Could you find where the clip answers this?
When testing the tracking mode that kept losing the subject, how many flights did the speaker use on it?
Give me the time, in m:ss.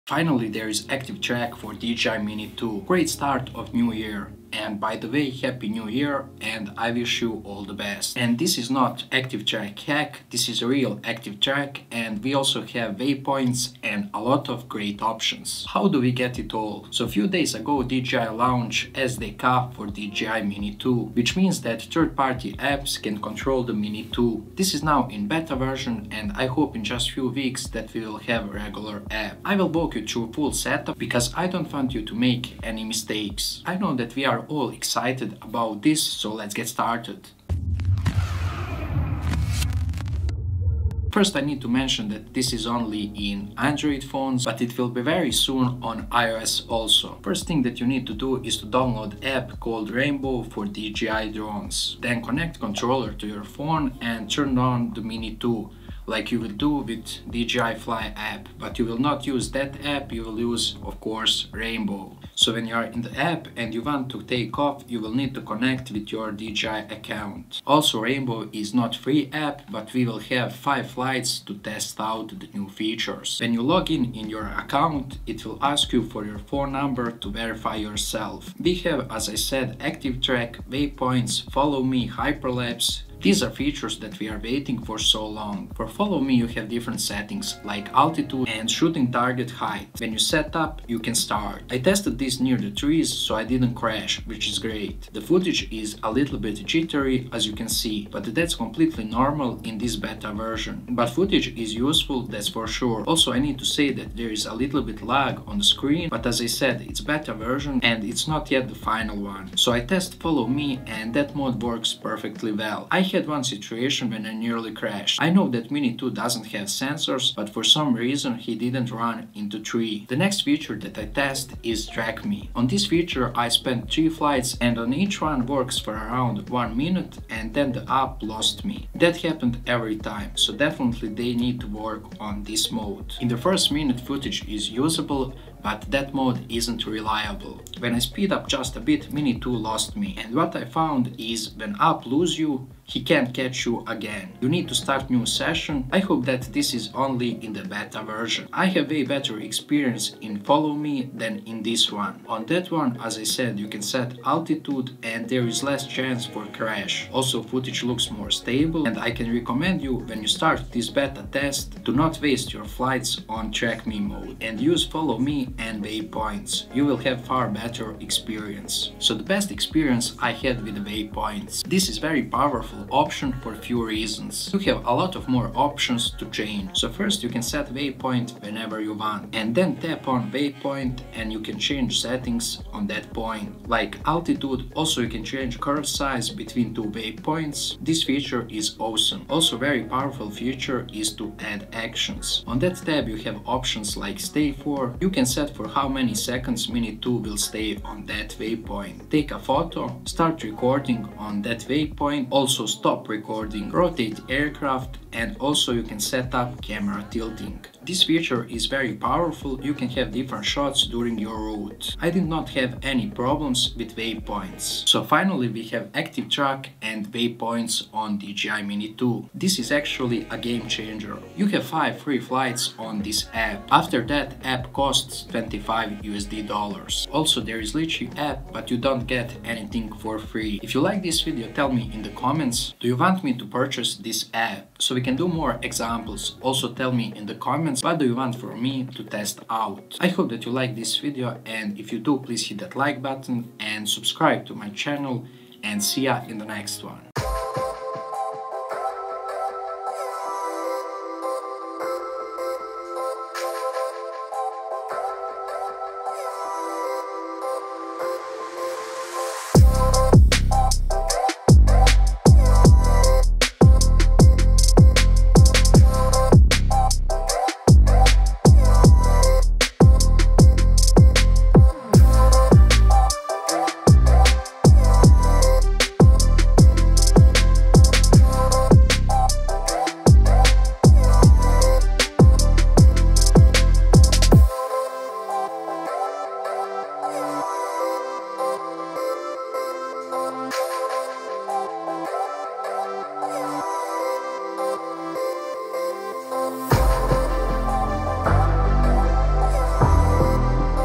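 2:03.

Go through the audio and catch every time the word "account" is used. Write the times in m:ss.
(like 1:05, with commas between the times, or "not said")
1:06, 1:14.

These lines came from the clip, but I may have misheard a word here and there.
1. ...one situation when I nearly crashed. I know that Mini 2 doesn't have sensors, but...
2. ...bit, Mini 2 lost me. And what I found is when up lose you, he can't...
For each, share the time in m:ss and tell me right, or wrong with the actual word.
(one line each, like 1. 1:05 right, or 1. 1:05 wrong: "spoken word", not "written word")
1. 1:53 right
2. 2:18 right.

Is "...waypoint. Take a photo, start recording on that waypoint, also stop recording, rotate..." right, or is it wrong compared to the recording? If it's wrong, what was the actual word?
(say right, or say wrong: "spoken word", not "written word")
right.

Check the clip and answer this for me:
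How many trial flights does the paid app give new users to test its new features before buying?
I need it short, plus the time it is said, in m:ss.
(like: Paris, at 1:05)
5, at 1:10.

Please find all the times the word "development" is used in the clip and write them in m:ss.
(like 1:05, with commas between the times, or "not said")
not said.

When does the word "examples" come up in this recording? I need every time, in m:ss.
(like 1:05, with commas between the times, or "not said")
3:55.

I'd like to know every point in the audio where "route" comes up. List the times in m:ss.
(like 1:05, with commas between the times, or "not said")
3:31.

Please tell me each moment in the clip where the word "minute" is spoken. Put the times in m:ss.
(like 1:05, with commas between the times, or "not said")
2:06, 2:13.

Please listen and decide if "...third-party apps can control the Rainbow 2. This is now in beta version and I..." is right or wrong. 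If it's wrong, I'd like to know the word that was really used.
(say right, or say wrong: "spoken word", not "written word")
wrong: "Mini", not "Rainbow".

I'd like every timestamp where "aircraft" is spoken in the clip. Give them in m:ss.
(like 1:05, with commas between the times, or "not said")
3:24.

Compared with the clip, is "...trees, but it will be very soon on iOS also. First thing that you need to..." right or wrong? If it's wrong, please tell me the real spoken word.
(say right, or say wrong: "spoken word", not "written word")
wrong: "phones", not "trees".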